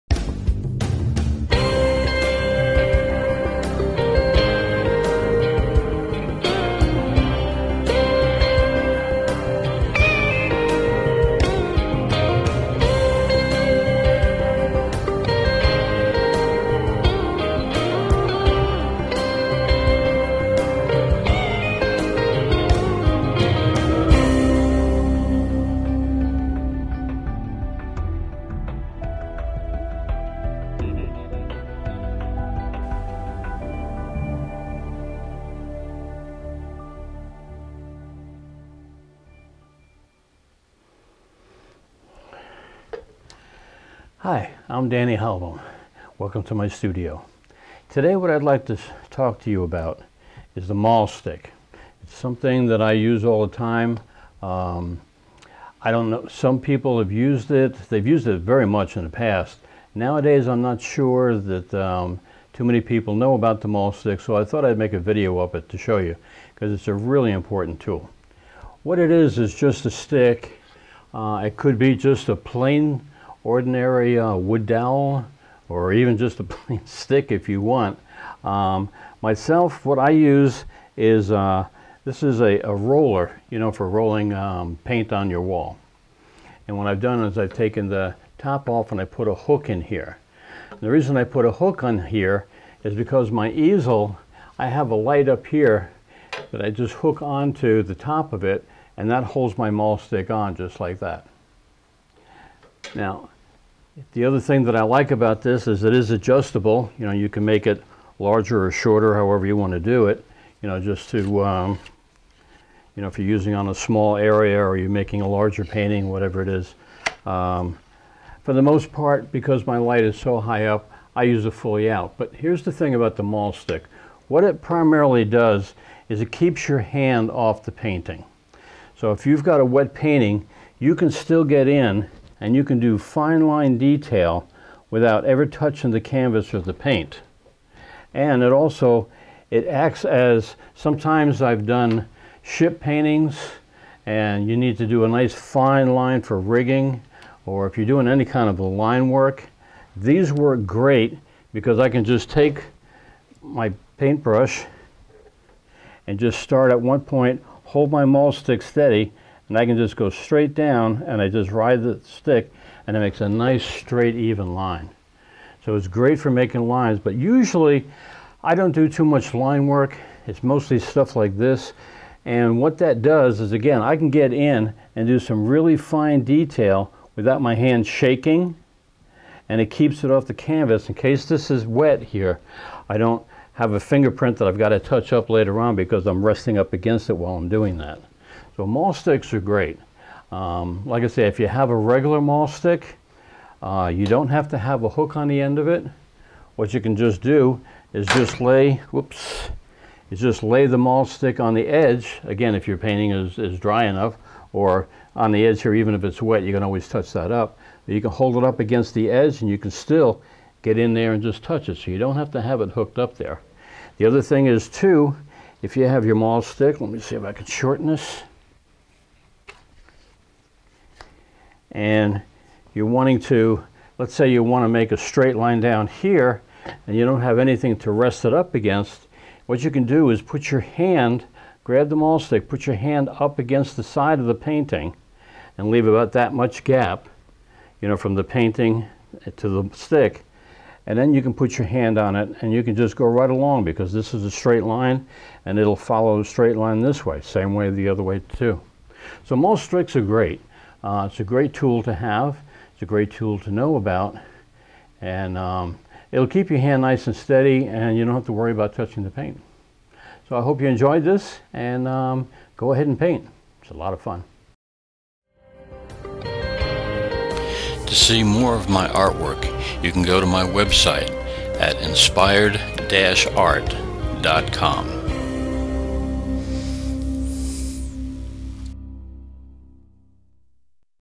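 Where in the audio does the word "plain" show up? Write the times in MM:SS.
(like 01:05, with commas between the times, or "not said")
01:12, 01:16.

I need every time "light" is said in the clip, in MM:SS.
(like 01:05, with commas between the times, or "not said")
01:34, 01:59.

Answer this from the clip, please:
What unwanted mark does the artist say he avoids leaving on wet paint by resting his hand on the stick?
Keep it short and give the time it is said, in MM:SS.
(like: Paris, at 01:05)
fingerprint, at 03:03.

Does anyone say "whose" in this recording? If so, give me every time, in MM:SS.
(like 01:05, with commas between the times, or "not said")
not said.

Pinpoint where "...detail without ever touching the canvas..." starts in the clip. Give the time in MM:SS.
02:13.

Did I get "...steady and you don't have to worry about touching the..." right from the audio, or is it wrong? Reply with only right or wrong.
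right.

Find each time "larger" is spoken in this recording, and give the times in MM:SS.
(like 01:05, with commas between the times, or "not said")
01:48, 01:55.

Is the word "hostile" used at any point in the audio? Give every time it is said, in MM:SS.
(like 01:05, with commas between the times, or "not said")
not said.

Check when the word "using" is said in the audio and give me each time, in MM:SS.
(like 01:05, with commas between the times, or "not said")
01:53.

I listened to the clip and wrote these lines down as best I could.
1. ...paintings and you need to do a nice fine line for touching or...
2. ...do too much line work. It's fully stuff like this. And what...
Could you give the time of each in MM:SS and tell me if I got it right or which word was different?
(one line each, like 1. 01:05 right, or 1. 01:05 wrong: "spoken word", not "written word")
1. 02:22 wrong: "rigging", not "touching"
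2. 02:48 wrong: "mostly", not "fully".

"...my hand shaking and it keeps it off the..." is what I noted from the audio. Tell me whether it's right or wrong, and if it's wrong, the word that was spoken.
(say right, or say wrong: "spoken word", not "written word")
right.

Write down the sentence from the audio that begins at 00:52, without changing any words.
It's something that I use all the time.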